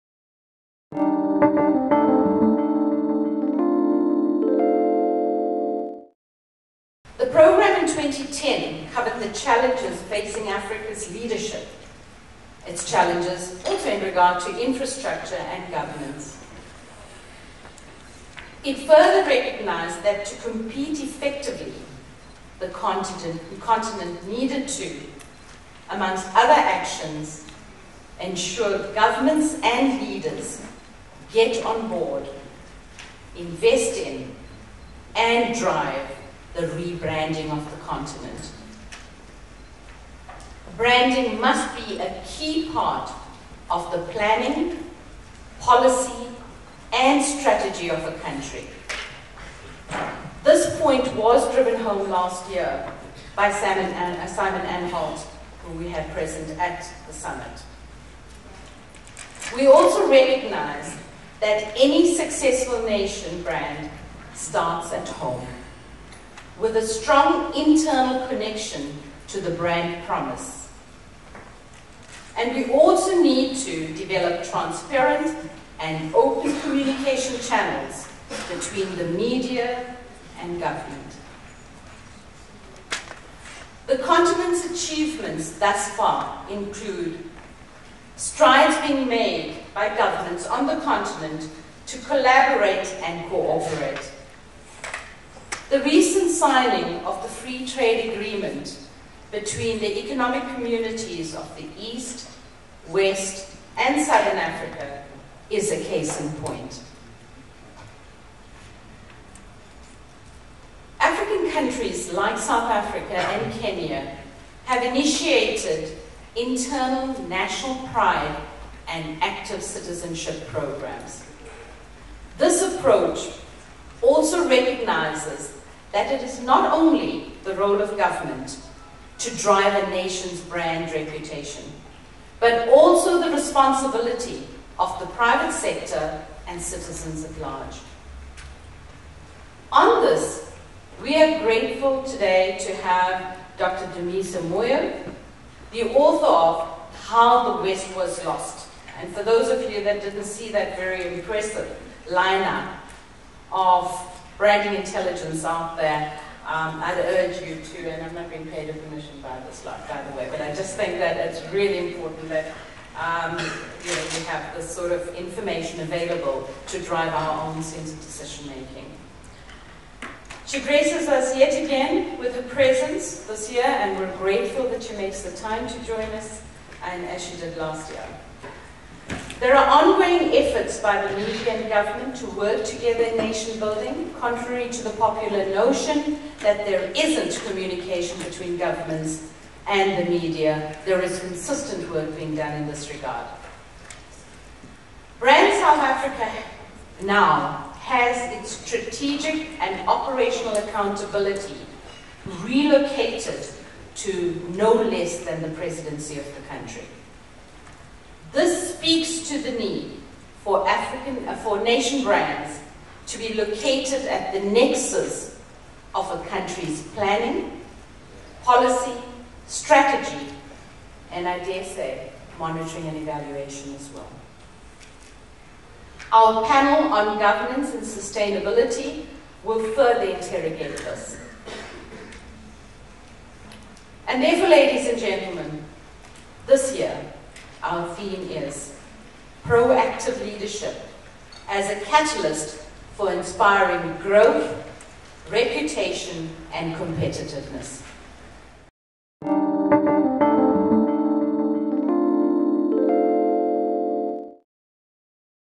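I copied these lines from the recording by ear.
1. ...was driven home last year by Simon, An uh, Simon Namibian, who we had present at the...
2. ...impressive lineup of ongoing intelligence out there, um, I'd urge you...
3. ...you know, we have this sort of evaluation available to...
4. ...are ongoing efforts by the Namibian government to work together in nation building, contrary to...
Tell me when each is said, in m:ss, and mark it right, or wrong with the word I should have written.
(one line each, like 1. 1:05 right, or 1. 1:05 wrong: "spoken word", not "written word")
1. 0:51 wrong: "Anholt", not "Namibian"
2. 2:31 wrong: "branding", not "ongoing"
3. 2:43 wrong: "information", not "evaluation"
4. 2:59 right.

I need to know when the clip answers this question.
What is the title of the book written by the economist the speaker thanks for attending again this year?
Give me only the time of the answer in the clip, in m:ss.
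2:27.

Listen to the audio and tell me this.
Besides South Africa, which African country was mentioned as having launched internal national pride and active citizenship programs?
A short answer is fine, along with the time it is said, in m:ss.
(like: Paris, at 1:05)
Kenya, at 1:53.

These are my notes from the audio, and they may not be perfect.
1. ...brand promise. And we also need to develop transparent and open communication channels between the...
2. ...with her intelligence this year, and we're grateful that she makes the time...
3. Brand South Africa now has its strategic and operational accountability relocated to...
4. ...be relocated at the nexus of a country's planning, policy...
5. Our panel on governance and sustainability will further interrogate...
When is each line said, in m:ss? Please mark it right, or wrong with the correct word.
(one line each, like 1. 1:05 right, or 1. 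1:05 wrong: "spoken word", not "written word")
1. 1:09 right
2. 2:52 wrong: "presence", not "intelligence"
3. 3:15 right
4. 3:33 wrong: "located", not "relocated"
5. 3:46 right.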